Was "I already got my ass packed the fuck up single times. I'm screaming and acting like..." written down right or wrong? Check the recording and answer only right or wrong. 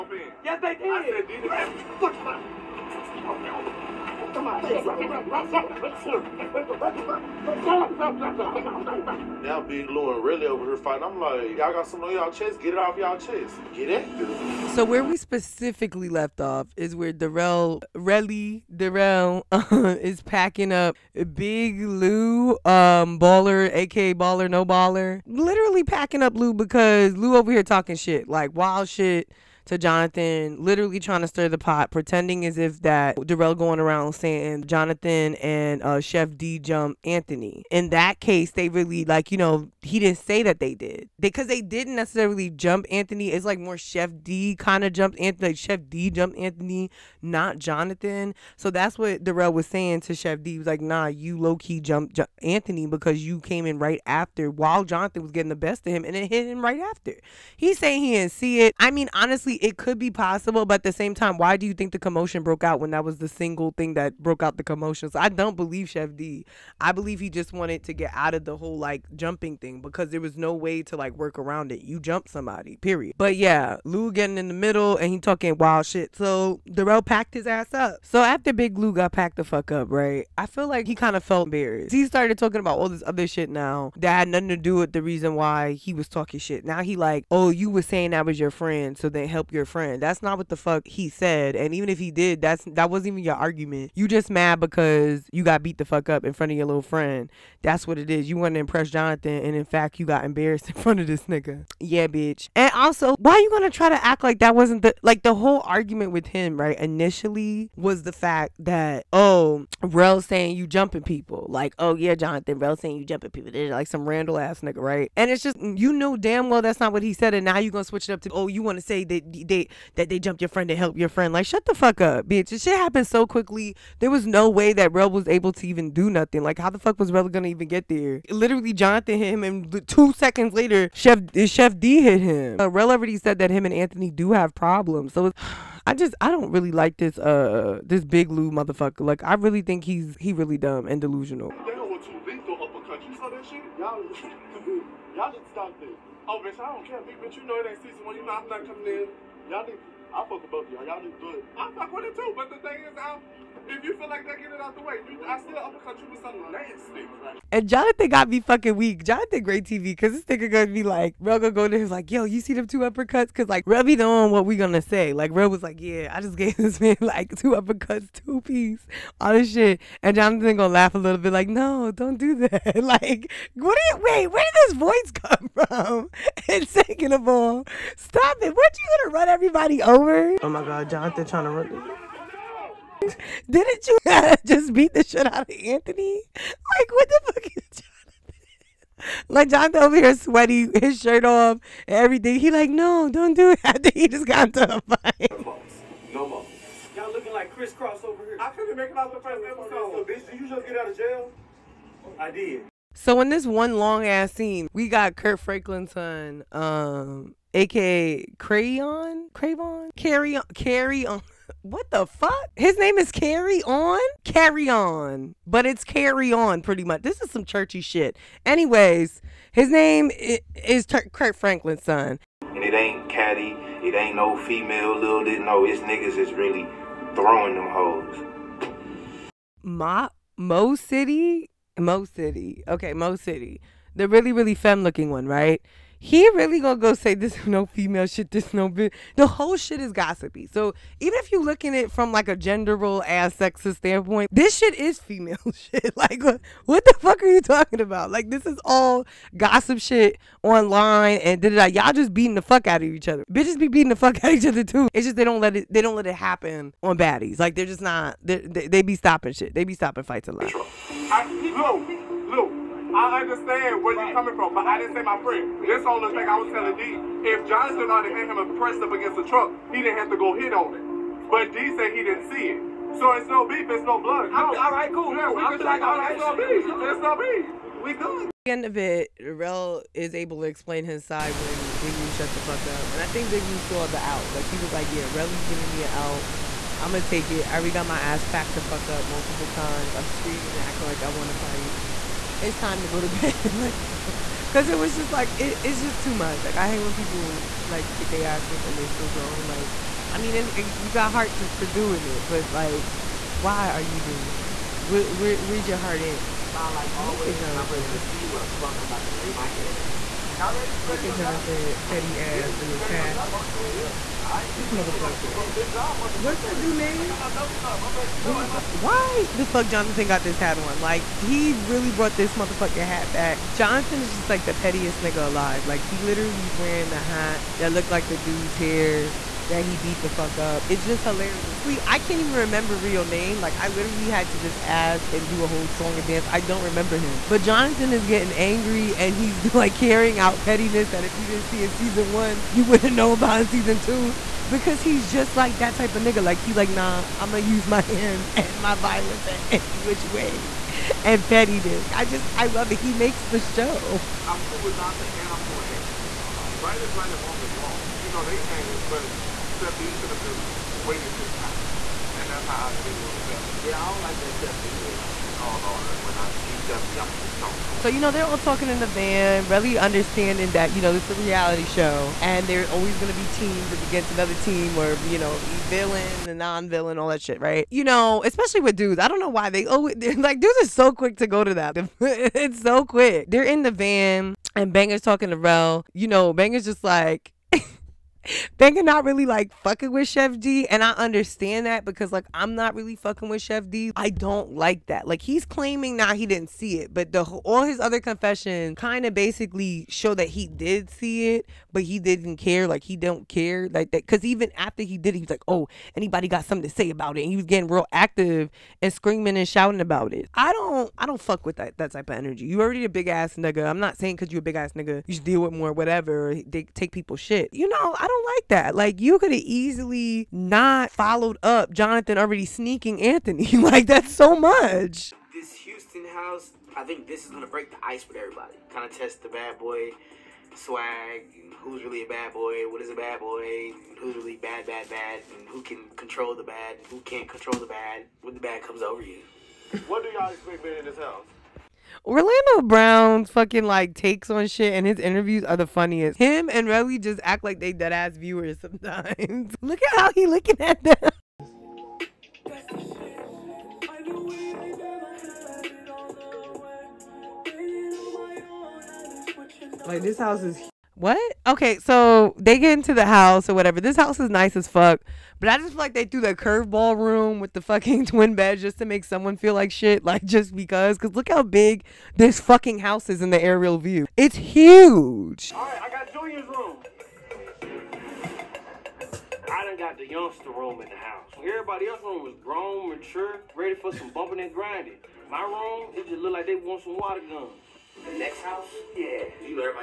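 wrong.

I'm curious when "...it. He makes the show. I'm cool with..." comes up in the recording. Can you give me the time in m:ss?
5:52.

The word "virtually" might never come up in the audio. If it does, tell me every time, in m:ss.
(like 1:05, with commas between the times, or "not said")
not said.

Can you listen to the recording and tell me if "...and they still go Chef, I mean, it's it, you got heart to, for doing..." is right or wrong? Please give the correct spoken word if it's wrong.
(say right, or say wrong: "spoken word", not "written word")
wrong: "Like", not "Chef".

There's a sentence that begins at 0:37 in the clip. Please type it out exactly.
In that case, they really like you know he didn't say that they did because they, didn't necessarily jump Anthony.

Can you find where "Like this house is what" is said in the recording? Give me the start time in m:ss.
7:39.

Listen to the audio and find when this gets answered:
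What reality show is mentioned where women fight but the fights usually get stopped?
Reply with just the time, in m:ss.
4:16.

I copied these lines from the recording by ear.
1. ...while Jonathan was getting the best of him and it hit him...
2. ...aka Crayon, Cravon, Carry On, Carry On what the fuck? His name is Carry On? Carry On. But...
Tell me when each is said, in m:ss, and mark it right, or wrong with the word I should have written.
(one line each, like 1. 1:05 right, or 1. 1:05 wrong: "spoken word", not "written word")
1. 0:54 right
2. 3:27 right.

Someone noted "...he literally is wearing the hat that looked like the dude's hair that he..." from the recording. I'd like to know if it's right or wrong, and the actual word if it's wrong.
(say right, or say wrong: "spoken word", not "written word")
right.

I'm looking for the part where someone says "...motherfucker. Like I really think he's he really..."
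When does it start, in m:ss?
2:18.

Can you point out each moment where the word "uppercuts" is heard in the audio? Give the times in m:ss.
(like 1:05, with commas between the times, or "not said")
2:35, 2:42, 2:47.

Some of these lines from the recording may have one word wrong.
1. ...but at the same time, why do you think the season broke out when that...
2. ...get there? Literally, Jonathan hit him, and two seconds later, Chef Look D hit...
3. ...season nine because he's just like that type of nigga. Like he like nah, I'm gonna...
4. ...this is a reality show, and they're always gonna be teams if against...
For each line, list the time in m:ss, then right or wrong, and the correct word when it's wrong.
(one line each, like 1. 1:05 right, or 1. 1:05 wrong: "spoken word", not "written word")
1. 1:00 wrong: "commotion", not "season"
2. 2:07 wrong: "Chef", not "Look"
3. 5:43 wrong: "two", not "nine"
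4. 6:10 right.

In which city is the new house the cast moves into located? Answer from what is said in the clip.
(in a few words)
Houston.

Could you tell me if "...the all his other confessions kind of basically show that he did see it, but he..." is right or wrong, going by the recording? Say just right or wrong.
right.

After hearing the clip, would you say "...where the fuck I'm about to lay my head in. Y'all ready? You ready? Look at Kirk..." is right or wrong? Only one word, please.
wrong.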